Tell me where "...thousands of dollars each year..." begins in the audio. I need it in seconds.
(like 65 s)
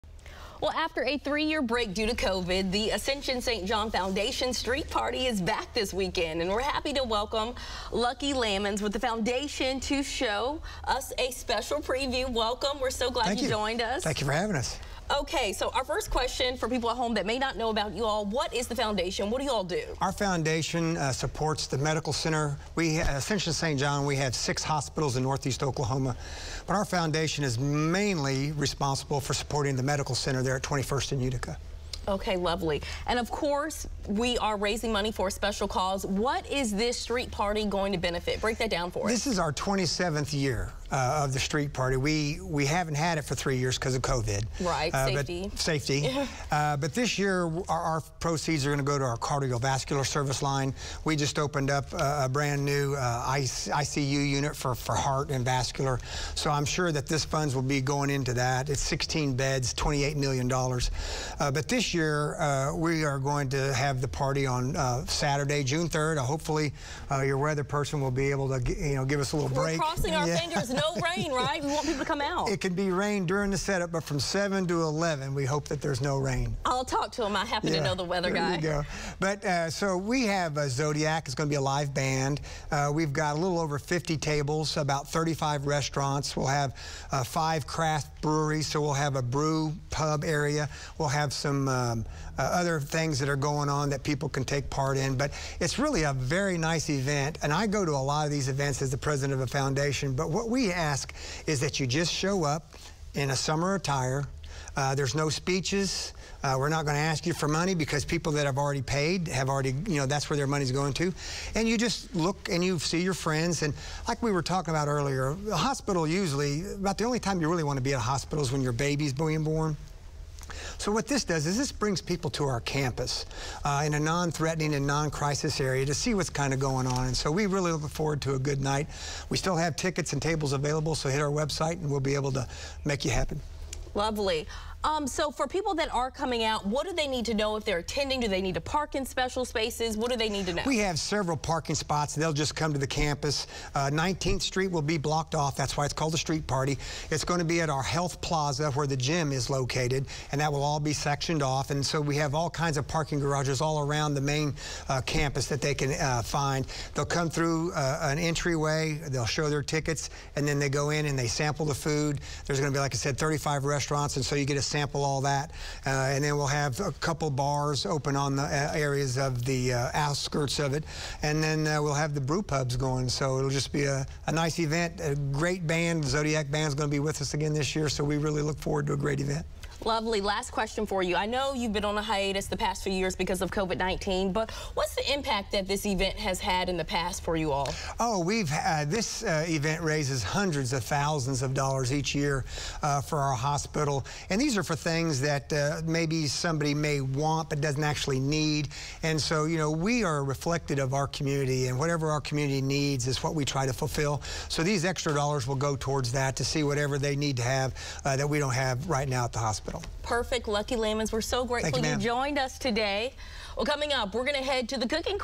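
190 s.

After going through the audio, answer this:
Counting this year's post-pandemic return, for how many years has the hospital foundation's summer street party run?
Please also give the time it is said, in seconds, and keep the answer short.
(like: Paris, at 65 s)
27th year, at 39 s.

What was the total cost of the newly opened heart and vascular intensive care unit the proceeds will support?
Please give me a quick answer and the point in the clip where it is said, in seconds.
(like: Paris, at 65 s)
$28 million, at 59 s.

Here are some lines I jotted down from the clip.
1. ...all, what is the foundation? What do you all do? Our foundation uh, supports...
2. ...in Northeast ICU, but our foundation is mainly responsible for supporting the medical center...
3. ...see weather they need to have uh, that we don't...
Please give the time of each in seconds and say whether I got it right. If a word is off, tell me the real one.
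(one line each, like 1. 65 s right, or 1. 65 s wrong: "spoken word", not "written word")
1. 18 s right
2. 25 s wrong: "Oklahoma", not "ICU"
3. 206 s wrong: "whatever", not "weather".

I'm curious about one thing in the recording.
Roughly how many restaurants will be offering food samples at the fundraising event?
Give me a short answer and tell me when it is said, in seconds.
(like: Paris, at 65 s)
35, at 84 s.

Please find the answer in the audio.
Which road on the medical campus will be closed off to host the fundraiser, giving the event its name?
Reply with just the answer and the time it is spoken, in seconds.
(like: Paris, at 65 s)
19th Street, at 143 s.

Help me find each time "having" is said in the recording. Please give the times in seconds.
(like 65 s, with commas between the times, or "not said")
14 s.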